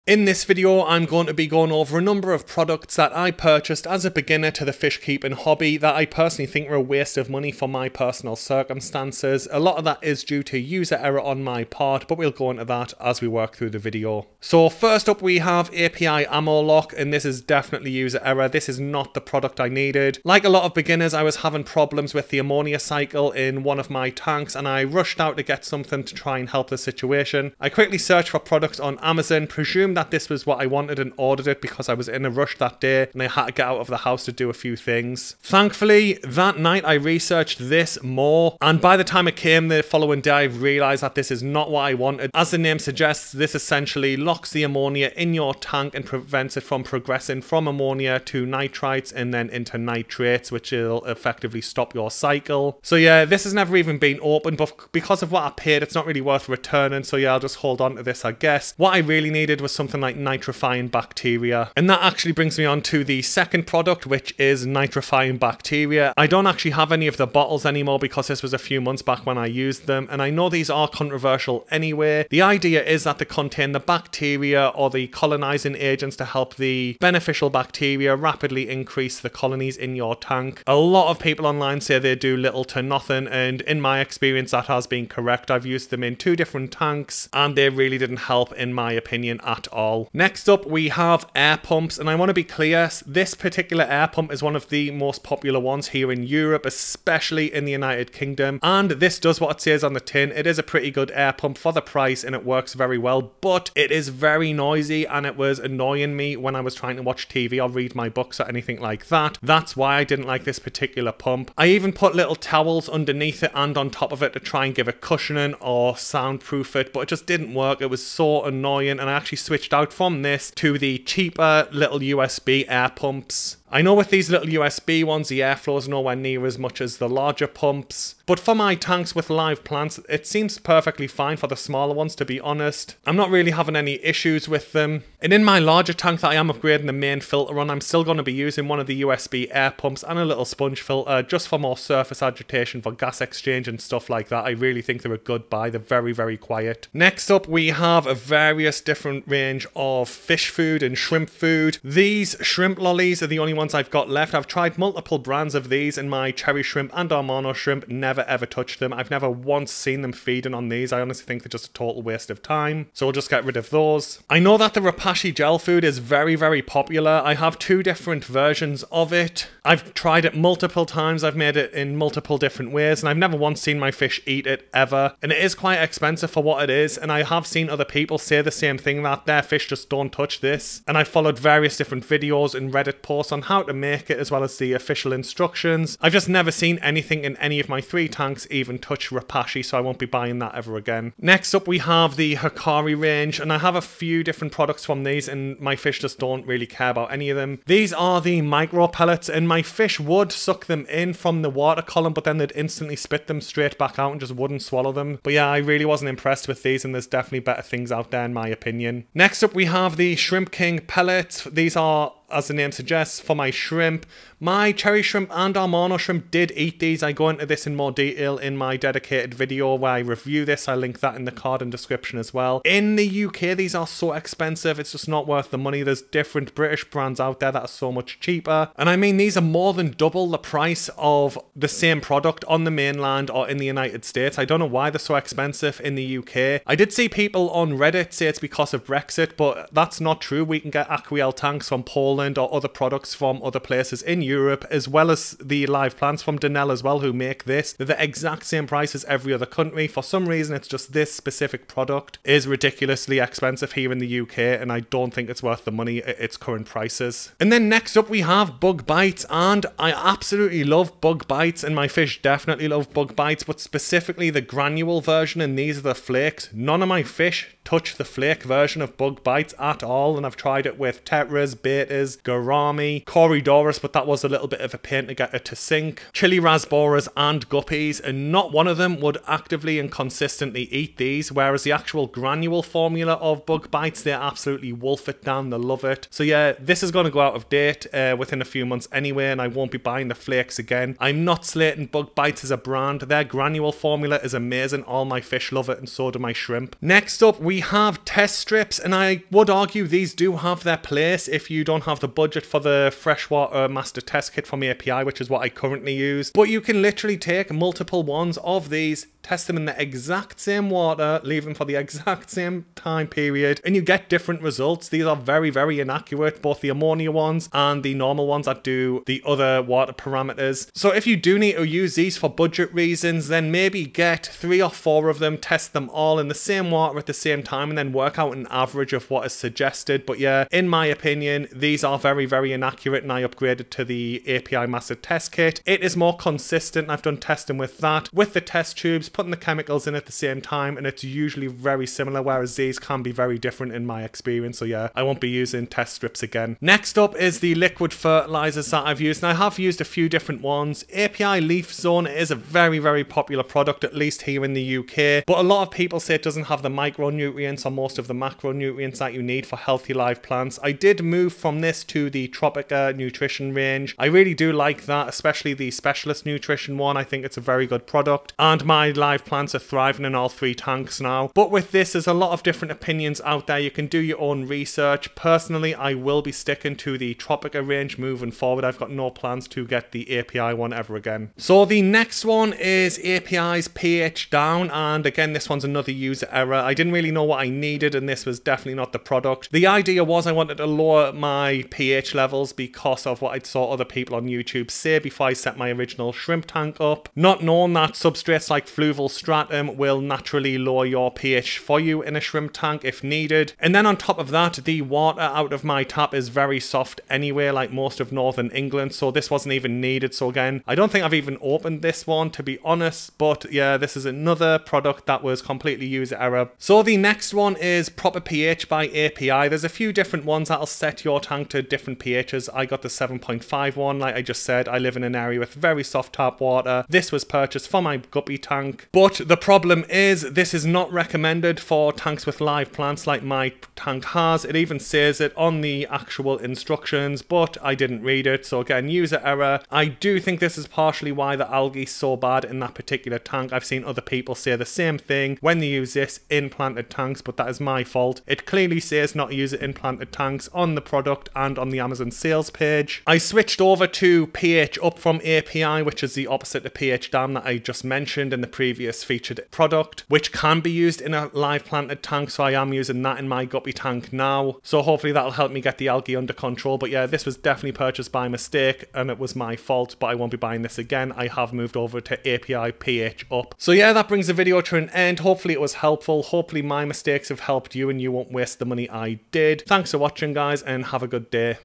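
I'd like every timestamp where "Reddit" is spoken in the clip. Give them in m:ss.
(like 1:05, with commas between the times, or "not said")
3:02, 3:57.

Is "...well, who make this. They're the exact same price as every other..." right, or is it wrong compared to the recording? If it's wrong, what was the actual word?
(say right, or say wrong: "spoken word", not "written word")
right.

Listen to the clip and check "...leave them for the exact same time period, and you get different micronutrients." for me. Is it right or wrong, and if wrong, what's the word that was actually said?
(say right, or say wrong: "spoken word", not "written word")
wrong: "results", not "micronutrients".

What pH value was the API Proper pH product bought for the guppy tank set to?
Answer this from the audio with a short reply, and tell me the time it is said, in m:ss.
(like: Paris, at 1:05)
7.5, at 7:02.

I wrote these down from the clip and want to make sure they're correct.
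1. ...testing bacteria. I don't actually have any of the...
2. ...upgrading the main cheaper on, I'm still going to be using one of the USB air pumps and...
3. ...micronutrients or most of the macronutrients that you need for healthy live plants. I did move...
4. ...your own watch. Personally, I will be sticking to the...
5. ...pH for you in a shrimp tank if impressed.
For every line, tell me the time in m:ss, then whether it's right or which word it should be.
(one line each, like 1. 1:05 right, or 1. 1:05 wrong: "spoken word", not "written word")
1. 1:04 wrong: "nitrifying", not "testing"
2. 2:16 wrong: "filter", not "cheaper"
3. 5:56 right
4. 6:13 wrong: "research", not "watch"
5. 6:41 wrong: "needed", not "impressed".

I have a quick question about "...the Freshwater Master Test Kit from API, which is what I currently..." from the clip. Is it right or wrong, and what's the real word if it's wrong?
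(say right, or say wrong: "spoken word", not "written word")
right.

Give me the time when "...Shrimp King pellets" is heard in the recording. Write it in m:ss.
3:30.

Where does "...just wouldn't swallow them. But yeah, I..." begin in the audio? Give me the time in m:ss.
3:24.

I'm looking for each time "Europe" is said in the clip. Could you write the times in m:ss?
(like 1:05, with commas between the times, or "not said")
1:36, 4:04.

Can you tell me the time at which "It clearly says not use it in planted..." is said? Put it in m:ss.
7:28.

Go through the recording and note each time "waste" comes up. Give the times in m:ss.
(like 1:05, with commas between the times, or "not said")
0:06, 2:42, 7:58.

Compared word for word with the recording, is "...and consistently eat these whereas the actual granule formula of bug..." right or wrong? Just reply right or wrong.
right.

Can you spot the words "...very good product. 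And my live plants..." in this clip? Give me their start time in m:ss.
6:07.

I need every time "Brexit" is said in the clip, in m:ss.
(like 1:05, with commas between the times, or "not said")
3:58.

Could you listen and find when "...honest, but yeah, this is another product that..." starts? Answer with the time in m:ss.
6:52.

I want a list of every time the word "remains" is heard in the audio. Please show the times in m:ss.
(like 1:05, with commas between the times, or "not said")
not said.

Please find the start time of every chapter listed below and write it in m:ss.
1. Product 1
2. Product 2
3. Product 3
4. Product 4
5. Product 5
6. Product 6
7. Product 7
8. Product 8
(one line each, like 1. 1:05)
1. 0:14
2. 1:01
3. 1:30
4. 2:26
5. 4:56
6. 5:46
7. 6:21
8. 6:59.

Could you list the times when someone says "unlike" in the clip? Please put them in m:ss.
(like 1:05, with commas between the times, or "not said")
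not said.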